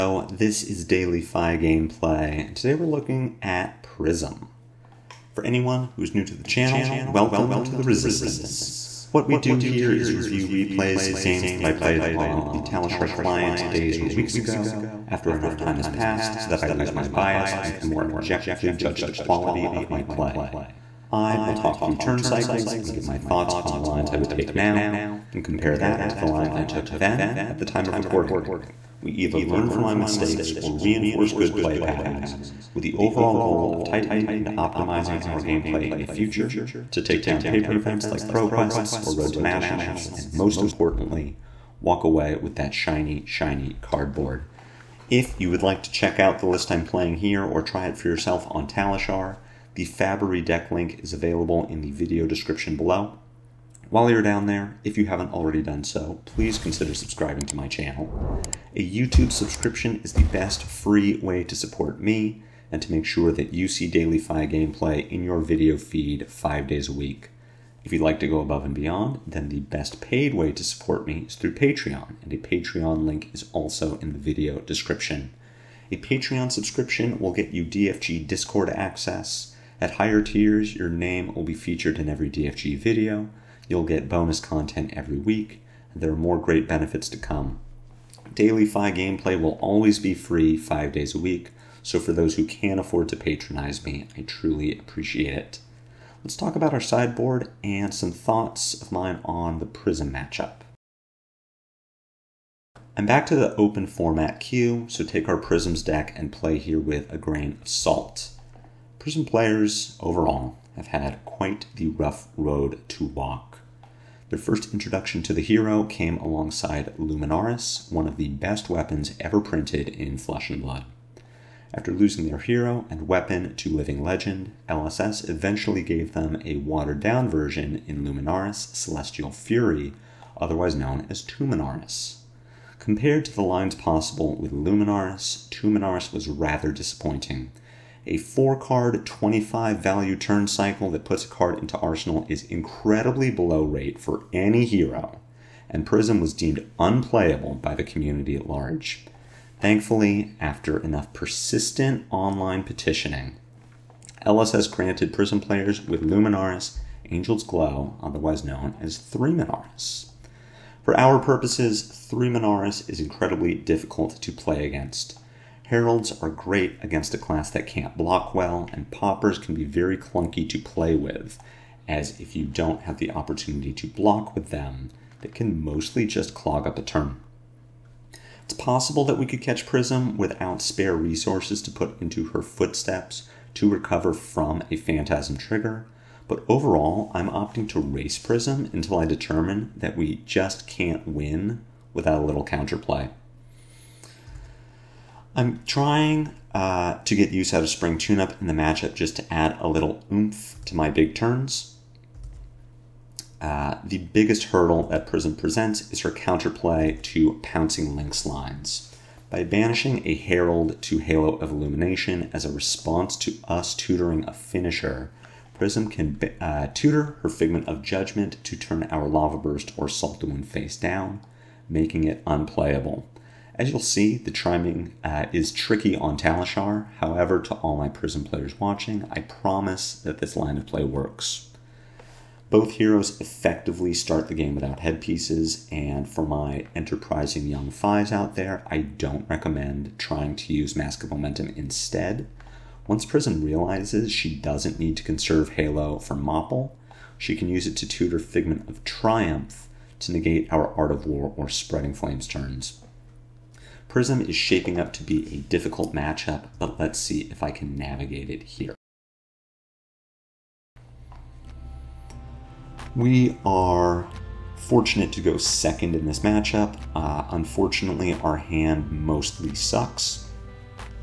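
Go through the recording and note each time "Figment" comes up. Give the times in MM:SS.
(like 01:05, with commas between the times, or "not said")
03:37, 04:08.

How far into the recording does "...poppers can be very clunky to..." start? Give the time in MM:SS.
02:48.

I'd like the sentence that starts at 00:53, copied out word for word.
While you're down there, if you haven't already done so, please consider subscribing to my channel.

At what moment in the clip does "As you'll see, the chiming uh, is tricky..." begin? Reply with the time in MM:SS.
03:43.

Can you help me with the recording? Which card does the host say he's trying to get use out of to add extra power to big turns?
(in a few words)
Spring Tune-Up.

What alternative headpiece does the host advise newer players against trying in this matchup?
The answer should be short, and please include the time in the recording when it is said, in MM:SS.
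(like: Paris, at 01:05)
Mask of Momentum, at 04:00.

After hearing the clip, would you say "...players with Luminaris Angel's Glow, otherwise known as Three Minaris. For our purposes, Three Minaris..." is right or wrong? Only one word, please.
right.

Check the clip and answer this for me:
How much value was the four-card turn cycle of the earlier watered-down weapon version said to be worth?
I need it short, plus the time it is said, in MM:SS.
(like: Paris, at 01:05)
25, at 02:19.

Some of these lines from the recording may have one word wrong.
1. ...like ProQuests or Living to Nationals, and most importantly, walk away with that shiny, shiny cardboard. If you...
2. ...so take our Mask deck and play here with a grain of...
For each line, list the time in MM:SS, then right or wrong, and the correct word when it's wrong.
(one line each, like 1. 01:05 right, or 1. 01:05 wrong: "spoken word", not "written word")
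1. 00:38 wrong: "Road", not "Living"
2. 01:44 wrong: "Prisms", not "Mask".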